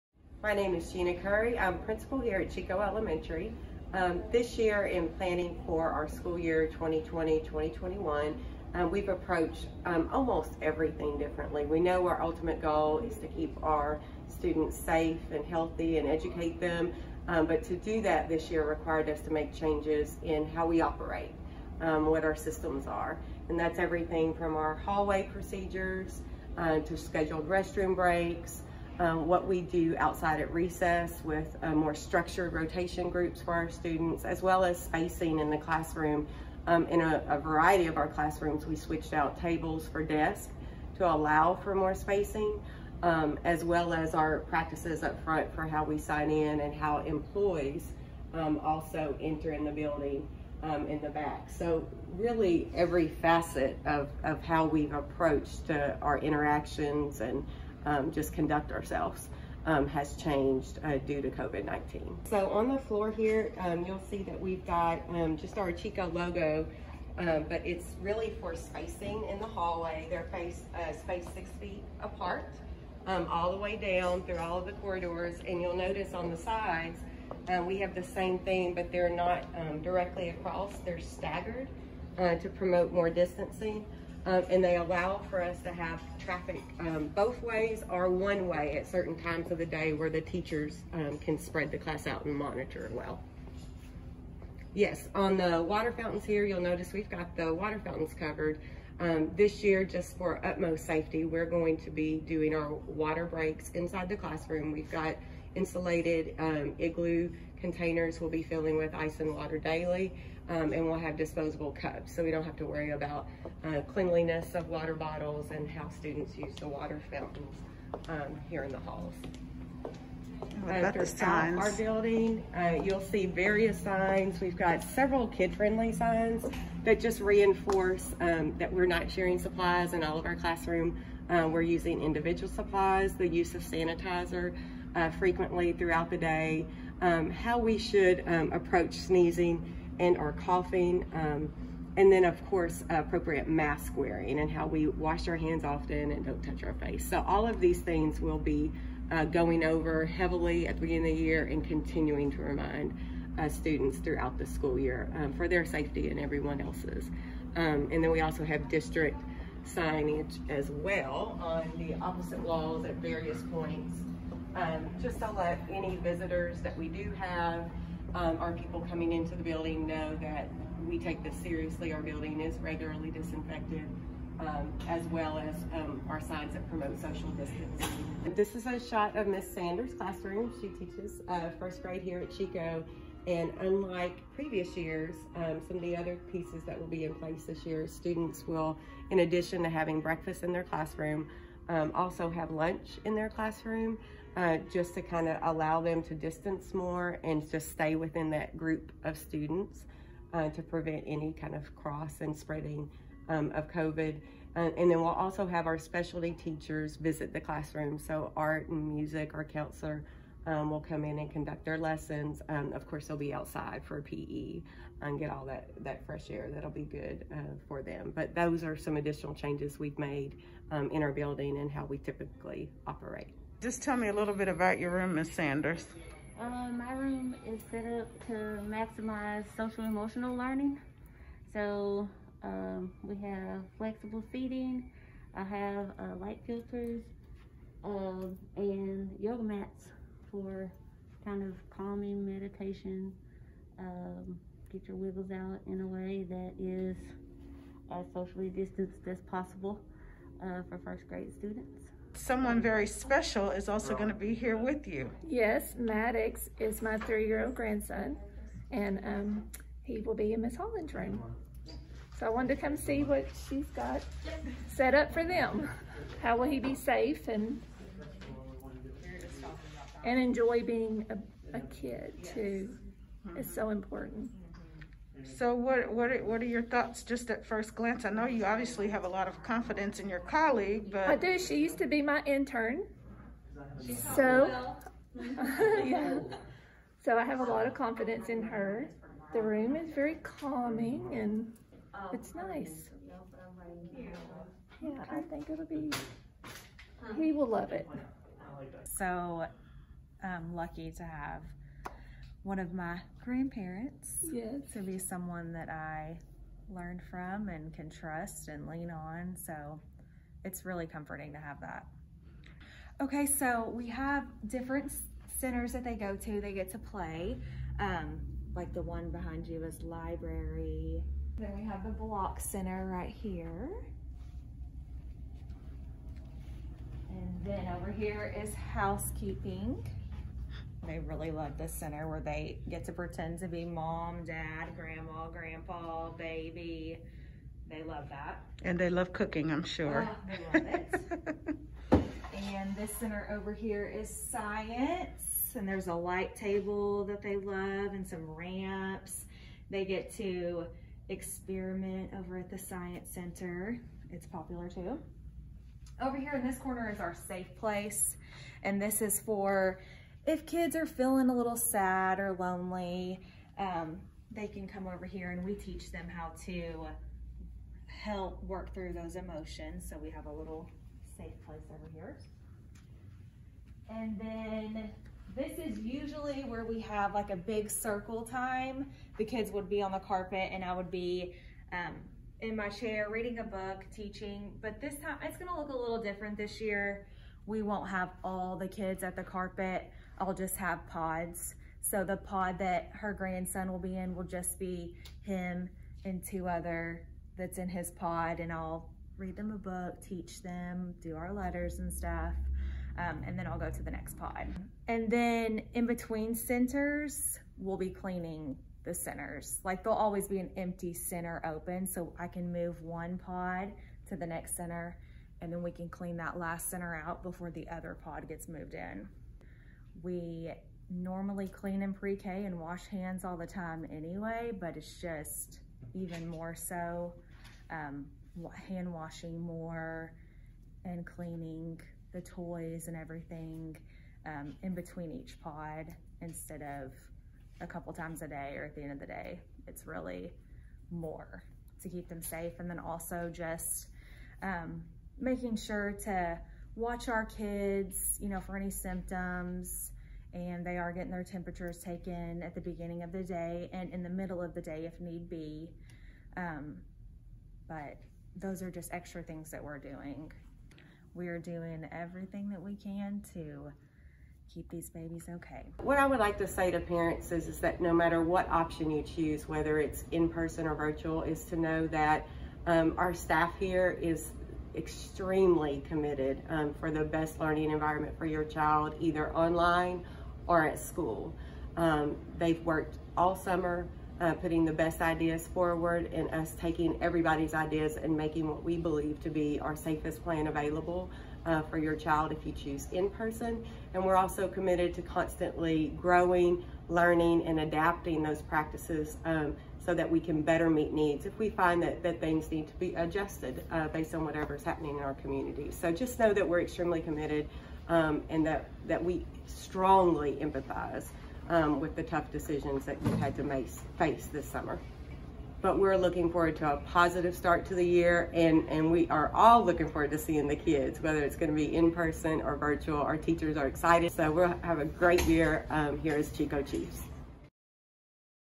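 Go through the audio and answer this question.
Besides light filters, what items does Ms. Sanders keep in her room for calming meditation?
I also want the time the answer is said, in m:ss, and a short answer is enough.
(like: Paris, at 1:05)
yoga mats, at 3:59.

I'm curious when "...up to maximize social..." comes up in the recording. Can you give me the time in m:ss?
3:47.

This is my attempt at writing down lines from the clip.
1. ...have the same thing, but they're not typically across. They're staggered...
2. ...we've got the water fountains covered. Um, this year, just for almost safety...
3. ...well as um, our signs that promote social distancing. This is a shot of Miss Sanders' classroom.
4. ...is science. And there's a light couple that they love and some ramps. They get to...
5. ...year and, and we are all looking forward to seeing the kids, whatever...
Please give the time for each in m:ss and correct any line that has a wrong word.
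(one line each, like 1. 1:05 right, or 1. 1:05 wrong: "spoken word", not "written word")
1. 1:17 wrong: "directly", not "typically"
2. 1:36 wrong: "utmost", not "almost"
3. 2:55 right
4. 5:43 wrong: "table", not "couple"
5. 8:37 wrong: "whether", not "whatever".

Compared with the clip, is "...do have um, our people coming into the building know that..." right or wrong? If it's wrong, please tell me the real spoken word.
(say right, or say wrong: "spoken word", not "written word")
right.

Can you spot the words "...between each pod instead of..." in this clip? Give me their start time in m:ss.
7:14.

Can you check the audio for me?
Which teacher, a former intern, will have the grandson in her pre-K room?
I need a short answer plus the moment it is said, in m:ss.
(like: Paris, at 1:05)
Miss Holland, at 4:20.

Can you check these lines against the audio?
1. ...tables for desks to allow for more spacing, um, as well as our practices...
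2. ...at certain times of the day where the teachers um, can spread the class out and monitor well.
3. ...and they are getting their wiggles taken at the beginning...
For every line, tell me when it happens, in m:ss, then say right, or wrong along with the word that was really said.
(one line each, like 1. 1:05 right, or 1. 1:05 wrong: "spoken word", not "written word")
1. 0:39 right
2. 1:28 right
3. 7:30 wrong: "temperatures", not "wiggles".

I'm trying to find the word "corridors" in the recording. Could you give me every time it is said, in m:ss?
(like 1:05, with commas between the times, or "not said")
1:14.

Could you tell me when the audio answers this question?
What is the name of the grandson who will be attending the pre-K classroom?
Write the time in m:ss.
4:15.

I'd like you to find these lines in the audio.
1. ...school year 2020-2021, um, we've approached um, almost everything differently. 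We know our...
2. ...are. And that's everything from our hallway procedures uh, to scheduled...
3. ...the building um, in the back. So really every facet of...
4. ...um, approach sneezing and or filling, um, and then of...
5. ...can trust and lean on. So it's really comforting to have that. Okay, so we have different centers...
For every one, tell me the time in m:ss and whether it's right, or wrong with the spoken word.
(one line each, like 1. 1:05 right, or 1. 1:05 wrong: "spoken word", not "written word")
1. 0:06 right
2. 0:22 right
3. 0:49 right
4. 2:18 wrong: "coughing", not "filling"
5. 5:07 right.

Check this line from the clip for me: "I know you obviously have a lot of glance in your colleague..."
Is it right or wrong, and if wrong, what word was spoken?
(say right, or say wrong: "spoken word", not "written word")
wrong: "confidence", not "glance".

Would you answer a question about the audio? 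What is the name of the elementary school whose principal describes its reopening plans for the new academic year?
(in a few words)
Chicot Elementary.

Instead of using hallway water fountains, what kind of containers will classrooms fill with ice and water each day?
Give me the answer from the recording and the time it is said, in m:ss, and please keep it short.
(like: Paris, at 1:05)
igloo containers, at 1:46.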